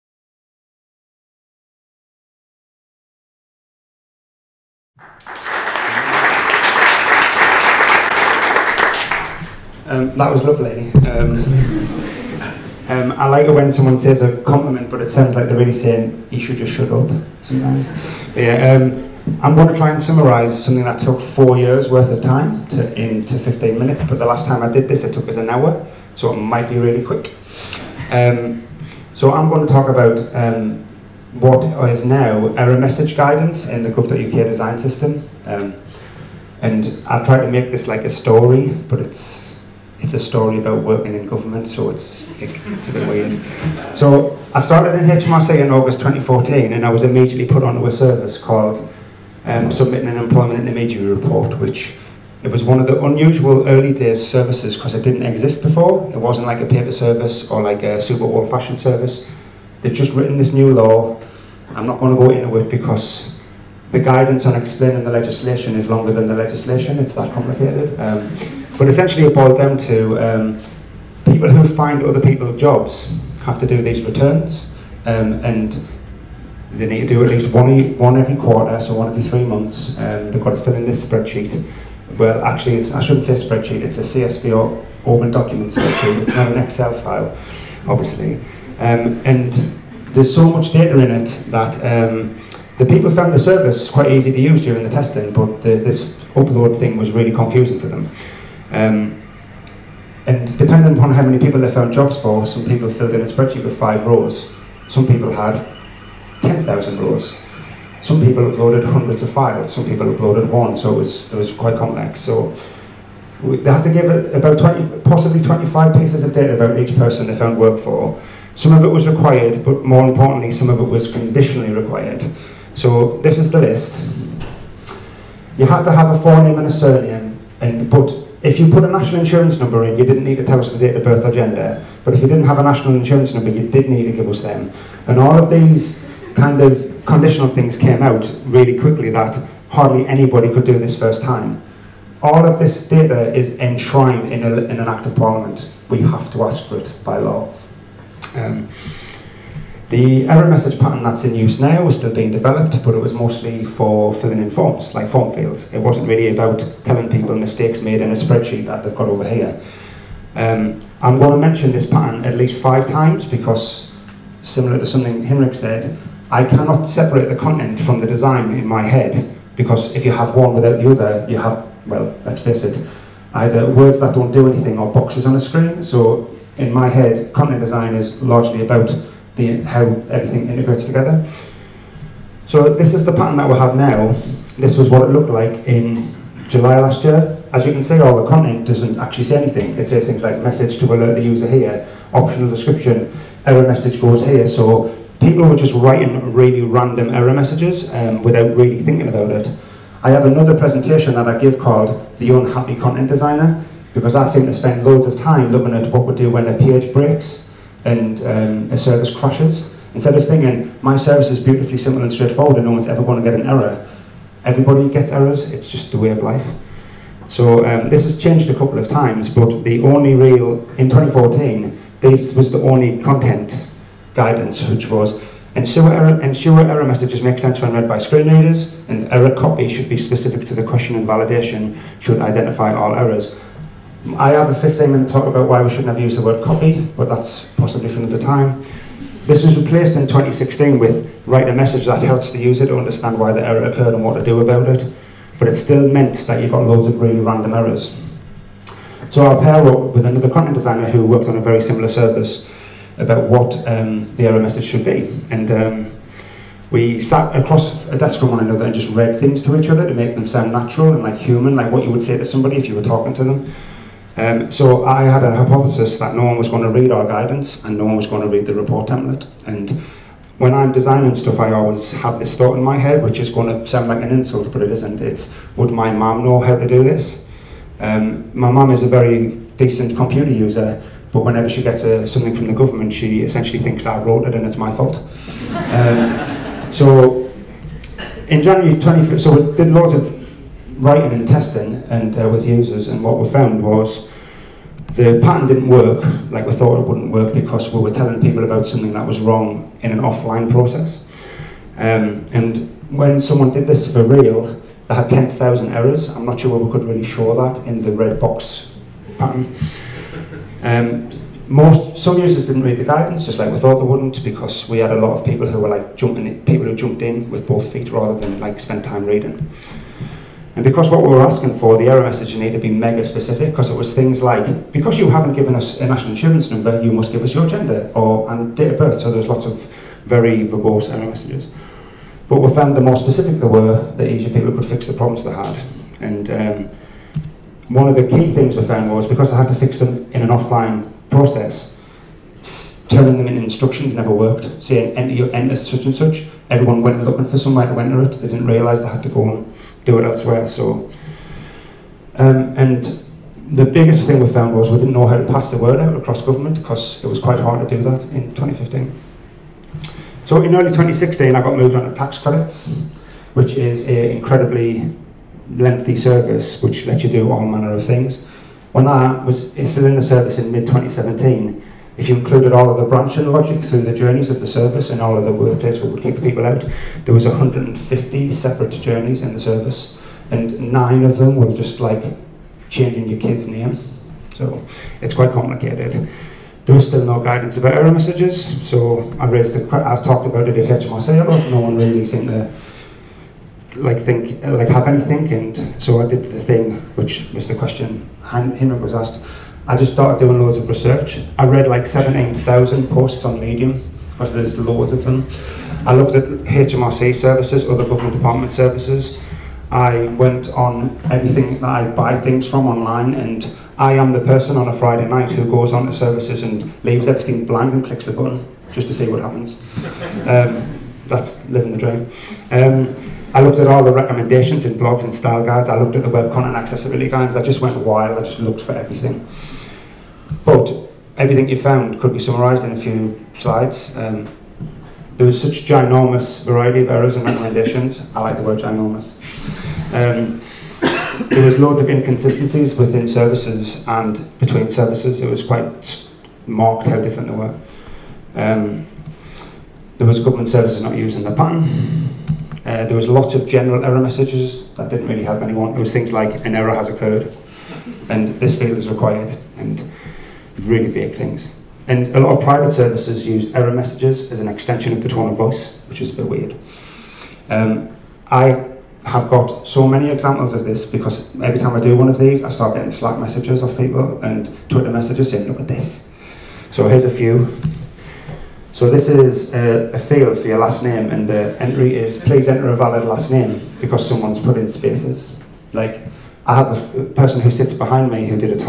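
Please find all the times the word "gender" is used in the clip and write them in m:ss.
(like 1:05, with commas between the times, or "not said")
2:11, 5:27.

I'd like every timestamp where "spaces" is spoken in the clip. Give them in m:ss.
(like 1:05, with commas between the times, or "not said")
8:04.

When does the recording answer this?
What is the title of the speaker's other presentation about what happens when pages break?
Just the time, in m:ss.
3:22.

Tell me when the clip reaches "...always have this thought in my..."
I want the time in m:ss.
4:31.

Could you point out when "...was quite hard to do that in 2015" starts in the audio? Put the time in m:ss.
5:57.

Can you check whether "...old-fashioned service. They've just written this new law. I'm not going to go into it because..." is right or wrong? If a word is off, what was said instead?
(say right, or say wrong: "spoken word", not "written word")
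right.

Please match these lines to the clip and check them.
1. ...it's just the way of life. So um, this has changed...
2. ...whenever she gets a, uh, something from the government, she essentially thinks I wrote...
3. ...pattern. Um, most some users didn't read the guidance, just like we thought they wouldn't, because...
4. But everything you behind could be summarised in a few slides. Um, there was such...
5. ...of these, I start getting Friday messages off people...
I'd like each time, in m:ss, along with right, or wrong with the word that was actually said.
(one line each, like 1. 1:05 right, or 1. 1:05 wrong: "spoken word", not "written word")
1. 3:35 right
2. 4:41 right
3. 5:09 right
4. 7:10 wrong: "found", not "behind"
5. 7:52 wrong: "Slack", not "Friday".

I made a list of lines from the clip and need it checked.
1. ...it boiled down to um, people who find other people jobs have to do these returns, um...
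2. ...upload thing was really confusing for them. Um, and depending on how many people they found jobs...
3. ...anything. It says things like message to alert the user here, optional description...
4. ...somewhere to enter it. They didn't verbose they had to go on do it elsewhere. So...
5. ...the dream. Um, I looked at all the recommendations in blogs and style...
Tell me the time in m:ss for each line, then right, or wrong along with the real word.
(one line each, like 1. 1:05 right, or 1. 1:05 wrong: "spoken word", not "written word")
1. 1:09 right
2. 1:36 right
3. 3:09 right
4. 5:47 wrong: "realise", not "verbose"
5. 7:01 right.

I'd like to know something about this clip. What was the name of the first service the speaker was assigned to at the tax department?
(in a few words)
Submitting an Employment Intermediary Report.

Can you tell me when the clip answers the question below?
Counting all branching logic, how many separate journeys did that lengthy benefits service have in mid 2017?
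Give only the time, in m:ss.
6:17.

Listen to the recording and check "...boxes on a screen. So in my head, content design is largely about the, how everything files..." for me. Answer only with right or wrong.
wrong.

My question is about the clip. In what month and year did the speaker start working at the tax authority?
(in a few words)
August 2014.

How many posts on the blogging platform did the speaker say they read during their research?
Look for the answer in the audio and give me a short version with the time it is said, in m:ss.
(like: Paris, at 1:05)
17,000, at 6:41.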